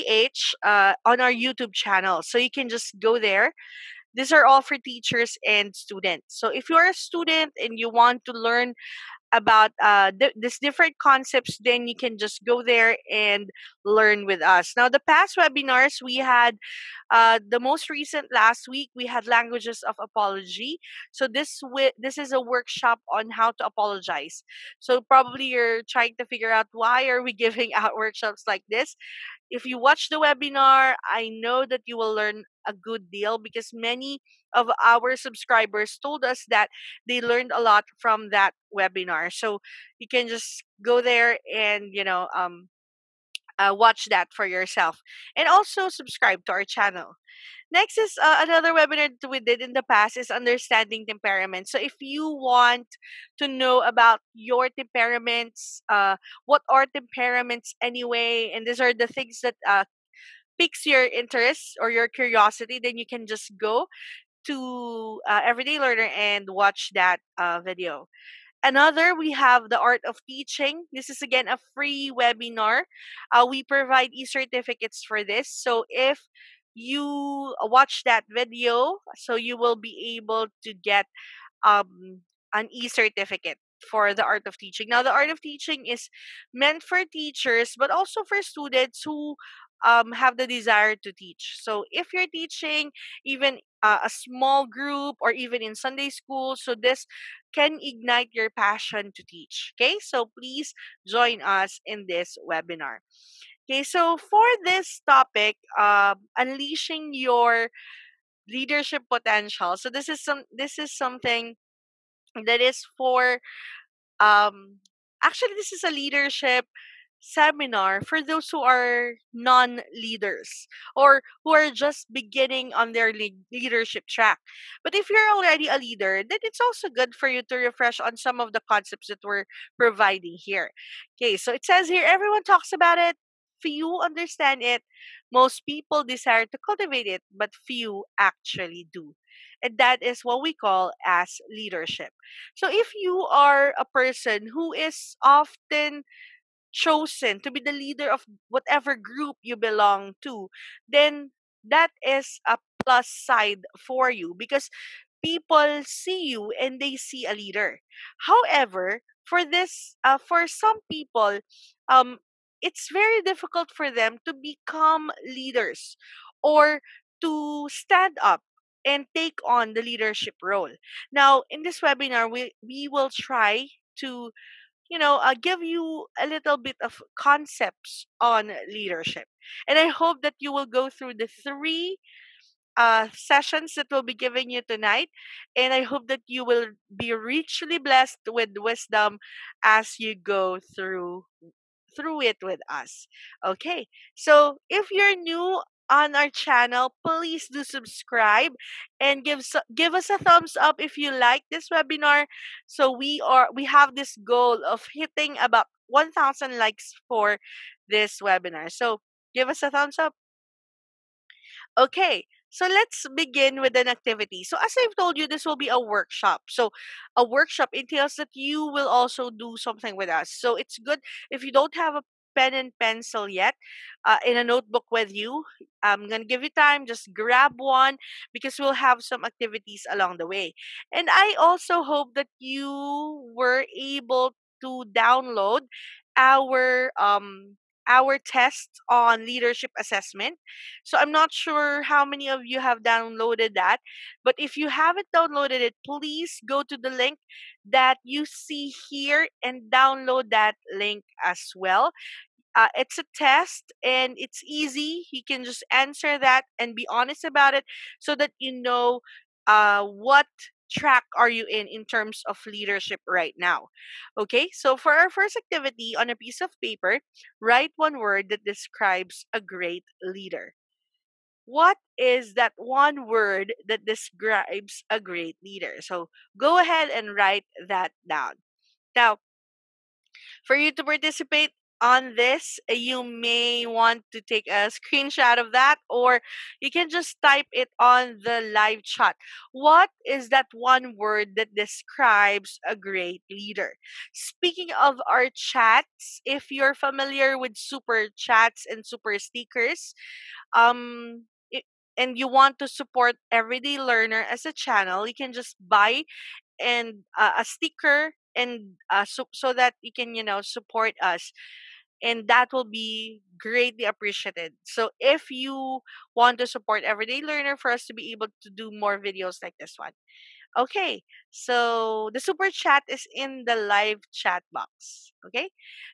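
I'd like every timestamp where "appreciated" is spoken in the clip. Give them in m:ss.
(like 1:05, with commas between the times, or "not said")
5:13.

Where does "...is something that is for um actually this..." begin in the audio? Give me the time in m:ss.
1:50.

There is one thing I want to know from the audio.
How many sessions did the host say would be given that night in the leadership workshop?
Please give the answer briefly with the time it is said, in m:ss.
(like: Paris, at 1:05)
3, at 3:01.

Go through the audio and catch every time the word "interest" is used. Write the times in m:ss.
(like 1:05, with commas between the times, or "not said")
1:01.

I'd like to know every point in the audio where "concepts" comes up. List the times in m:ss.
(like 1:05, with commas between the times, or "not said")
0:11, 2:08, 2:57.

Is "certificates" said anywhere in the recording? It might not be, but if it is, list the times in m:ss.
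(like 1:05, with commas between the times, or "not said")
1:14, 1:22.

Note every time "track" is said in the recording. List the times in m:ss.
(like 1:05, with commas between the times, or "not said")
2:04, 4:20.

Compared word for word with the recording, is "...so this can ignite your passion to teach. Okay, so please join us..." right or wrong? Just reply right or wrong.
right.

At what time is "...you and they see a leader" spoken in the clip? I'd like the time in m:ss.
2:36.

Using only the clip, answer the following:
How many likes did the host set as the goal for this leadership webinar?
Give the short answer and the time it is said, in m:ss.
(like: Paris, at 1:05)
1000, at 3:25.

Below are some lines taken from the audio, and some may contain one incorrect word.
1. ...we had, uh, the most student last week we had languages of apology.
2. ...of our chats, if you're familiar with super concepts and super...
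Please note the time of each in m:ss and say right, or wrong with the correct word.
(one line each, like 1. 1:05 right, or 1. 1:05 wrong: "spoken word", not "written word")
1. 0:16 wrong: "recent", not "student"
2. 4:54 wrong: "chats", not "concepts".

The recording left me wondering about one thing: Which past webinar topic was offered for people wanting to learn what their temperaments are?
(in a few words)
Understanding temperament.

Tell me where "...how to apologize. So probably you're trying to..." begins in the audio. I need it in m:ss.
0:23.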